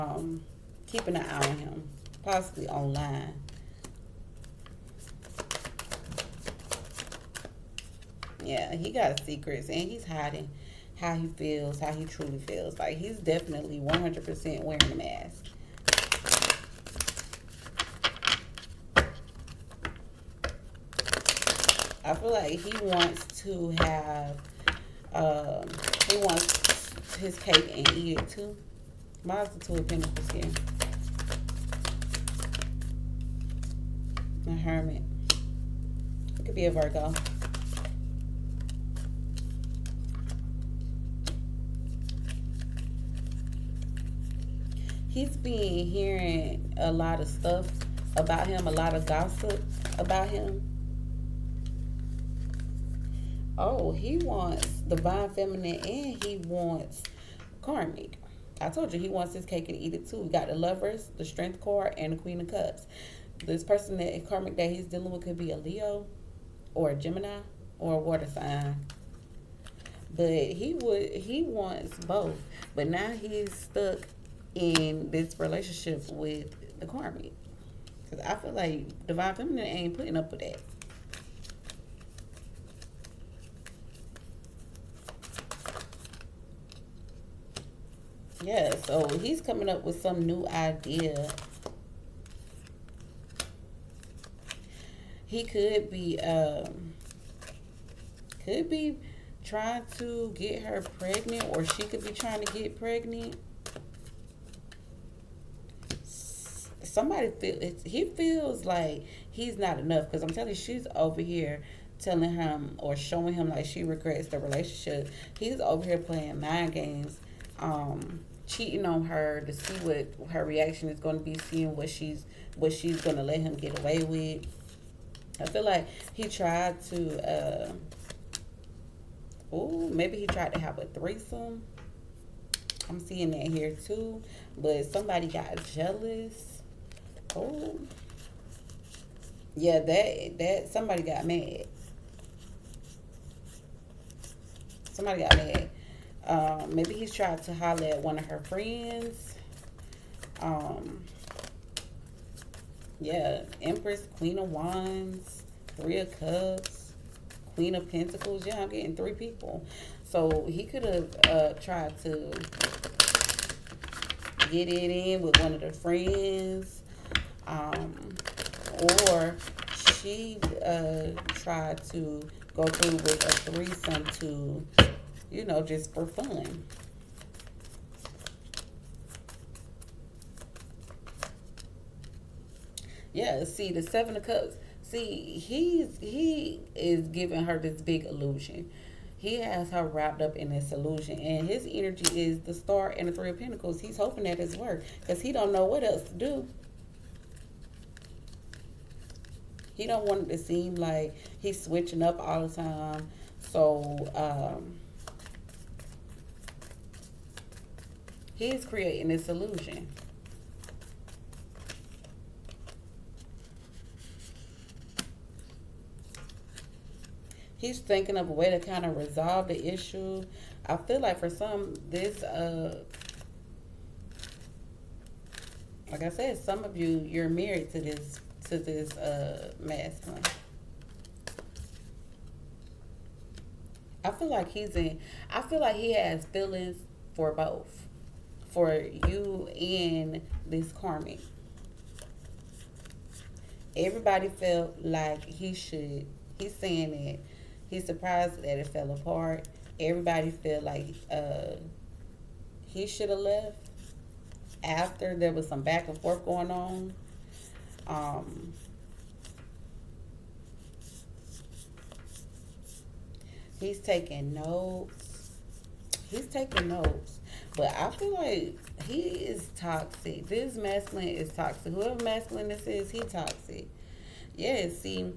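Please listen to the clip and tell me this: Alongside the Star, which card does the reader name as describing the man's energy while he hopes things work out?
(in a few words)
Three of Pentacles.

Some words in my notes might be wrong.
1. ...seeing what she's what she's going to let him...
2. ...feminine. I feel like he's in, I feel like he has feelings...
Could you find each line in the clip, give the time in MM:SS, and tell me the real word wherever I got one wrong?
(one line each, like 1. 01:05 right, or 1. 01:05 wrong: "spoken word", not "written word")
1. 02:01 right
2. 03:49 wrong: "masculine", not "feminine".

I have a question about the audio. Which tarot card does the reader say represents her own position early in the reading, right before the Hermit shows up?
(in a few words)
Two of Pentacles.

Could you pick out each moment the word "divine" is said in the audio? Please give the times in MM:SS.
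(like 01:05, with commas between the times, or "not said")
00:54, 01:19.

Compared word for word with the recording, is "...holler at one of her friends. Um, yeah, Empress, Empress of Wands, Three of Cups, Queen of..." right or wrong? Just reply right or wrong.
wrong.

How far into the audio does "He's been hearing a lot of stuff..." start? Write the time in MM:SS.
00:45.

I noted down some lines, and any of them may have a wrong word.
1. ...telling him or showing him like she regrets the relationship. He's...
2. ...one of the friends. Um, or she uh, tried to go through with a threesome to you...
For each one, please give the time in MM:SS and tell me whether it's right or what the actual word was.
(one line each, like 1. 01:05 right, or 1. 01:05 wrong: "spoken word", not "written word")
1. 01:51 right
2. 02:45 right.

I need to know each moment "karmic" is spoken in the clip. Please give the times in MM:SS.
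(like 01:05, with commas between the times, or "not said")
00:57, 01:04, 01:16, 04:00.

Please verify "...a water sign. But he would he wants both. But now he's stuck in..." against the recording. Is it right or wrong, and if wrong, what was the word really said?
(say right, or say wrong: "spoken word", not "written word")
right.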